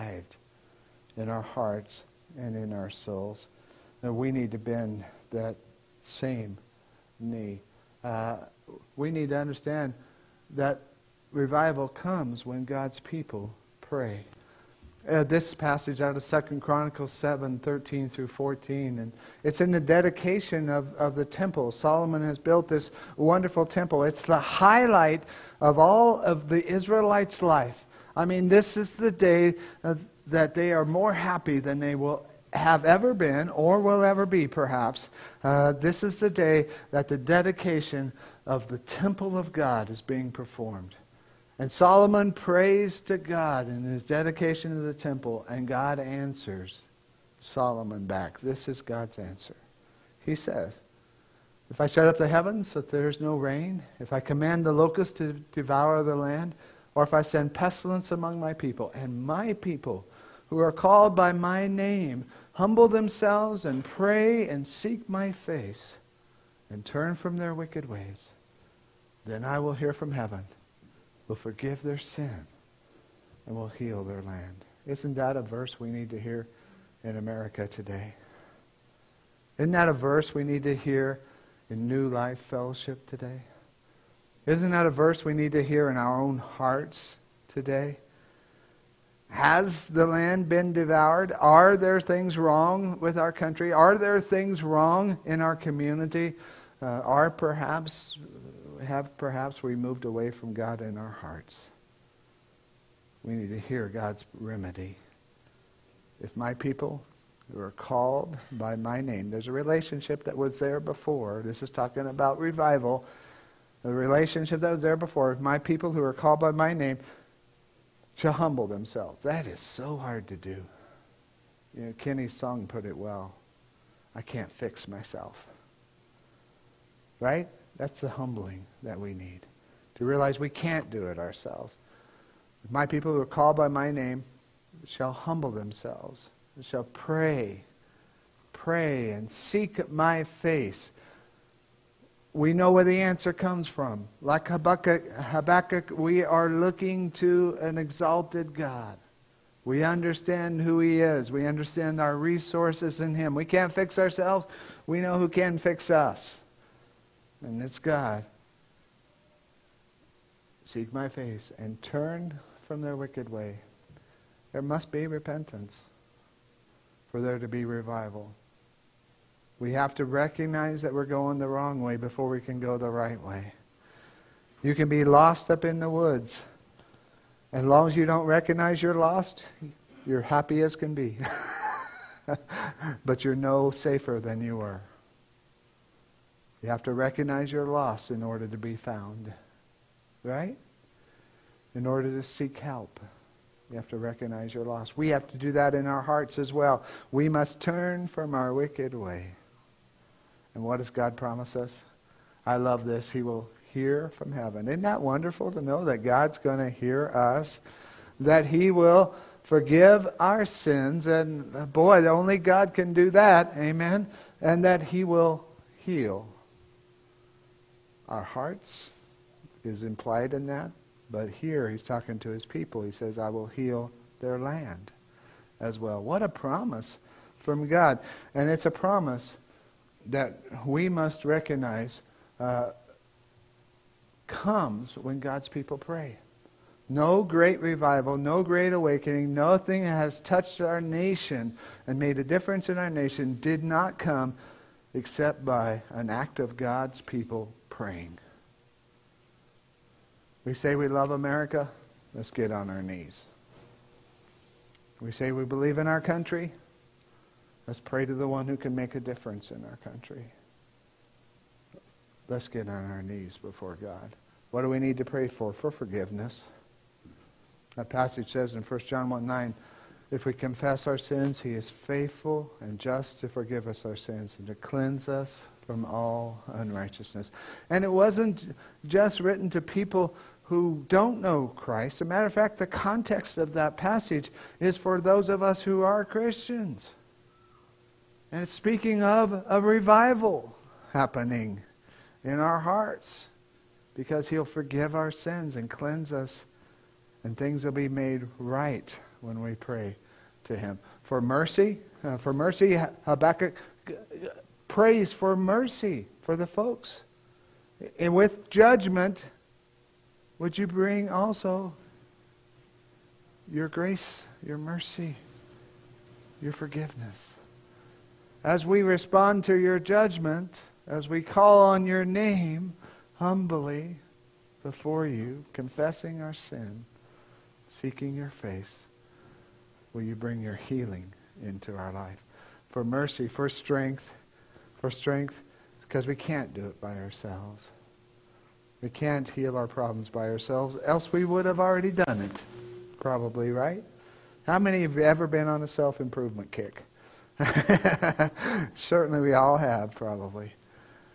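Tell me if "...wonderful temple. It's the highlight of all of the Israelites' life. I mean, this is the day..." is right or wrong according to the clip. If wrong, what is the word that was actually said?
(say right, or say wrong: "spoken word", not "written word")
right.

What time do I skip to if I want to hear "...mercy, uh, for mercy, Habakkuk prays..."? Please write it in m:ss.
5:01.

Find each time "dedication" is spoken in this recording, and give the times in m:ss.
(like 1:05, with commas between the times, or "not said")
0:19, 0:37, 0:44.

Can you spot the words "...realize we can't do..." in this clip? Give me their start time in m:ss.
2:10.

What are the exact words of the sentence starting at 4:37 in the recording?
And it wasn't just written to people who don't know Christ.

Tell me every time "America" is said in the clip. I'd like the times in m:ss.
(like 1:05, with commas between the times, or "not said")
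1:17, 4:11.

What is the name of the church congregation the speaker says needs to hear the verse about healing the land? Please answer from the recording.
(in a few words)
New Life Fellowship.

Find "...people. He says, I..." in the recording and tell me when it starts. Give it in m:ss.
3:42.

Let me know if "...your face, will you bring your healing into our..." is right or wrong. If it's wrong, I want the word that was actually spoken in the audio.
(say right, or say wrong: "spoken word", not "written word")
right.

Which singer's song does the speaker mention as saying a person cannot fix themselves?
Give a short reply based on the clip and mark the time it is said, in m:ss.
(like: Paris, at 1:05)
Kenny, at 2:01.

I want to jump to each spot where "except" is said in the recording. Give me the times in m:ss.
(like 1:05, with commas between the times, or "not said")
4:04.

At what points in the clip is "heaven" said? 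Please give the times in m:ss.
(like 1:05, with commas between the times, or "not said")
0:52, 1:10, 3:24.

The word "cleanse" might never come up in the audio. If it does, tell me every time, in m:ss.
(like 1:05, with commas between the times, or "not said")
4:34, 4:55.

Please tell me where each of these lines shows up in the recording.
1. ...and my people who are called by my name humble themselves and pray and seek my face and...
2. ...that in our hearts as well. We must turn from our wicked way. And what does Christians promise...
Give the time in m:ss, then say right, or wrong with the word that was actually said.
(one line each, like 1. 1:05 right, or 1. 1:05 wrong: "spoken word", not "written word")
1. 0:58 right
2. 3:15 wrong: "God", not "Christians".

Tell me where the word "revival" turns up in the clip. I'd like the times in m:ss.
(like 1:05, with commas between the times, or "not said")
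0:11, 1:52, 2:47, 3:57, 4:49.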